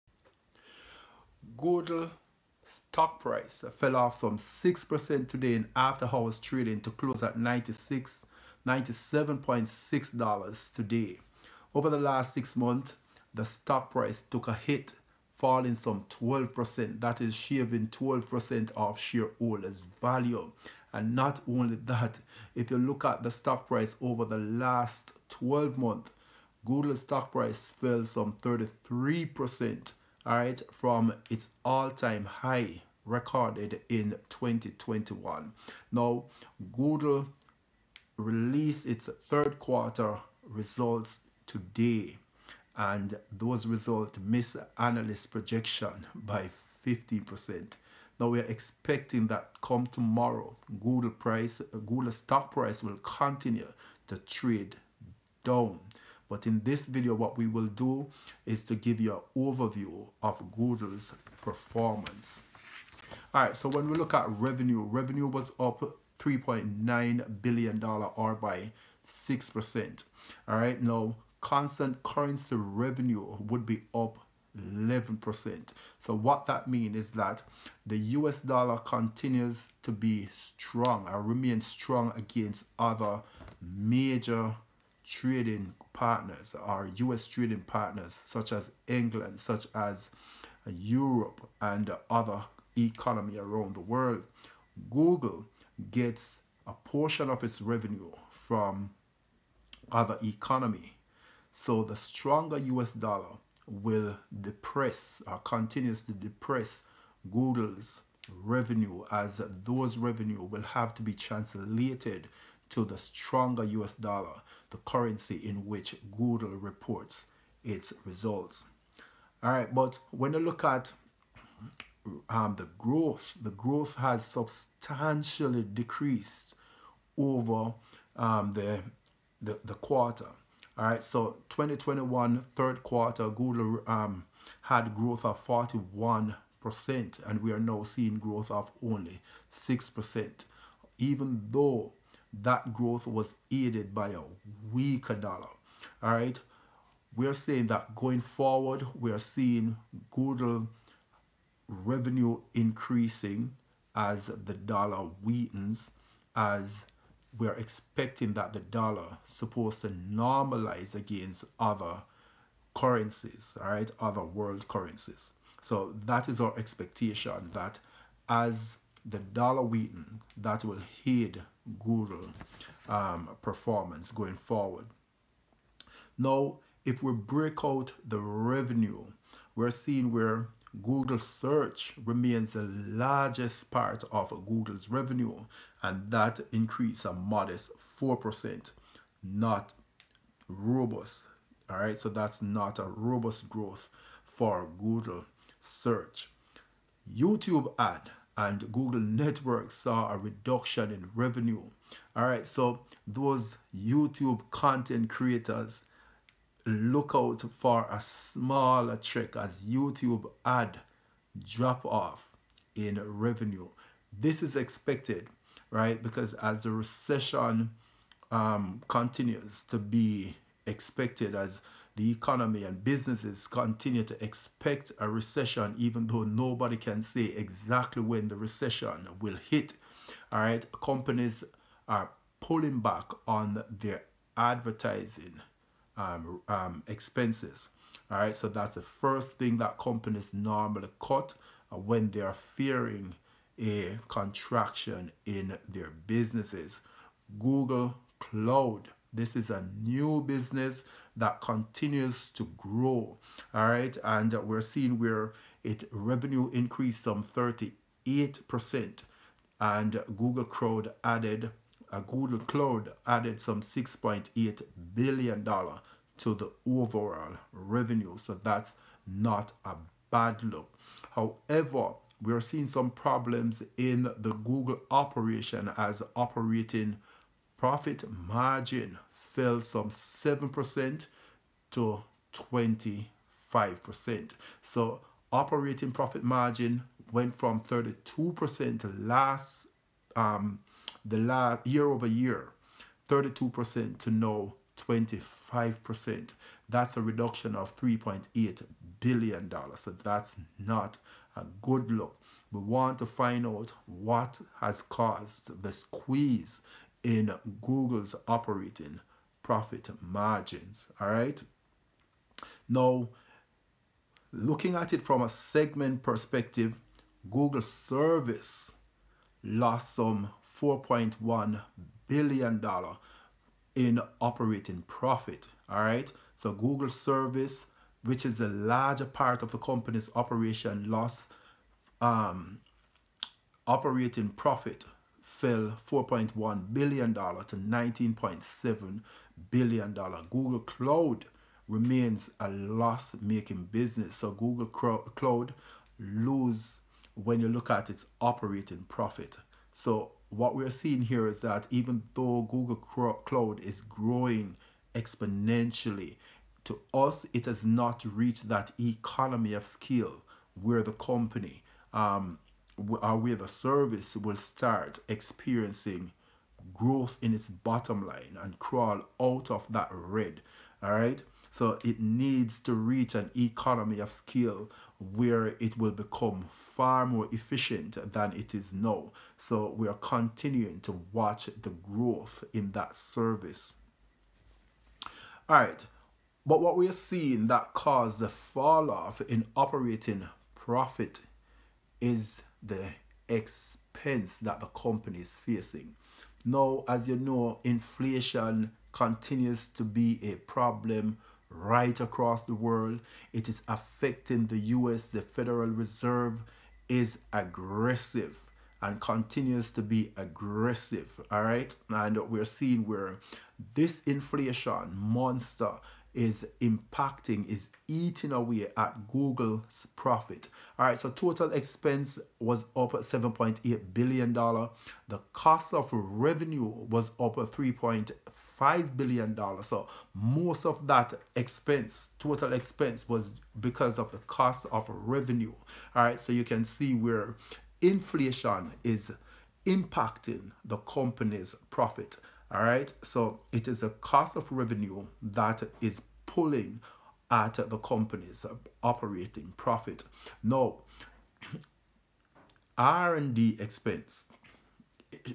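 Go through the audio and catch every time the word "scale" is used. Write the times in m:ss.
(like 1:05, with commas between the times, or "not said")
5:59, 6:14.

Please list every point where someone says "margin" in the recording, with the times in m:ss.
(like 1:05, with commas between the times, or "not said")
4:38, 4:46, 5:10.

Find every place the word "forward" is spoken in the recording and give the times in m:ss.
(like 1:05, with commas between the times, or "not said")
2:28, 2:54.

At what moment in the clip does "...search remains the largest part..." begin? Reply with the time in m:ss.
3:01.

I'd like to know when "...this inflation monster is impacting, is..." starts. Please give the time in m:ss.
6:53.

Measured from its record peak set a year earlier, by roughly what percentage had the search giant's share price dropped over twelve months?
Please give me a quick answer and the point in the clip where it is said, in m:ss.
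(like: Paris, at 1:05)
33%, at 0:28.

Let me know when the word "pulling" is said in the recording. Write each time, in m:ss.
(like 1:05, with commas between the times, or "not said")
3:52, 7:26.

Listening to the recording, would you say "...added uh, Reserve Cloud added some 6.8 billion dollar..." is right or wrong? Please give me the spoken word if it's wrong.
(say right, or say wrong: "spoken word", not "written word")
wrong: "Google", not "Reserve".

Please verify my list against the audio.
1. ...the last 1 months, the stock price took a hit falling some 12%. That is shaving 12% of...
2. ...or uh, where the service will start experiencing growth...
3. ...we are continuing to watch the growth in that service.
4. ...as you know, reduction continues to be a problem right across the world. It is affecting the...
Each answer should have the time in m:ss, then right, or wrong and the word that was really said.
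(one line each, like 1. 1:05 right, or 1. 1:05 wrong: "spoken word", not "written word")
1. 0:11 wrong: "6", not "1"
2. 6:02 right
3. 6:19 right
4. 6:36 wrong: "inflation", not "reduction".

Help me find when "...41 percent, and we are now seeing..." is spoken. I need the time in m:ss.
2:15.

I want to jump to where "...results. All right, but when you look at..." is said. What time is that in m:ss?
1:58.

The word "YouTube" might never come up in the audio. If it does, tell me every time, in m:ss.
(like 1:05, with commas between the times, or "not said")
3:17, 3:23, 3:29.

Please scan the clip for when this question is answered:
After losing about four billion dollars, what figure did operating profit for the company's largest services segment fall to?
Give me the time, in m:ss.
5:37.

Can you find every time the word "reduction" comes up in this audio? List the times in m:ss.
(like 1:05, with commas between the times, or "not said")
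3:20, 4:57.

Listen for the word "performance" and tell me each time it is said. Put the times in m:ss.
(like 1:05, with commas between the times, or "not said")
1:01, 2:53.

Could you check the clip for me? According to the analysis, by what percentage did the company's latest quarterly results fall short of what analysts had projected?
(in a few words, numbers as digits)
15%.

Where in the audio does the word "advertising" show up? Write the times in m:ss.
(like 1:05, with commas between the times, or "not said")
3:54.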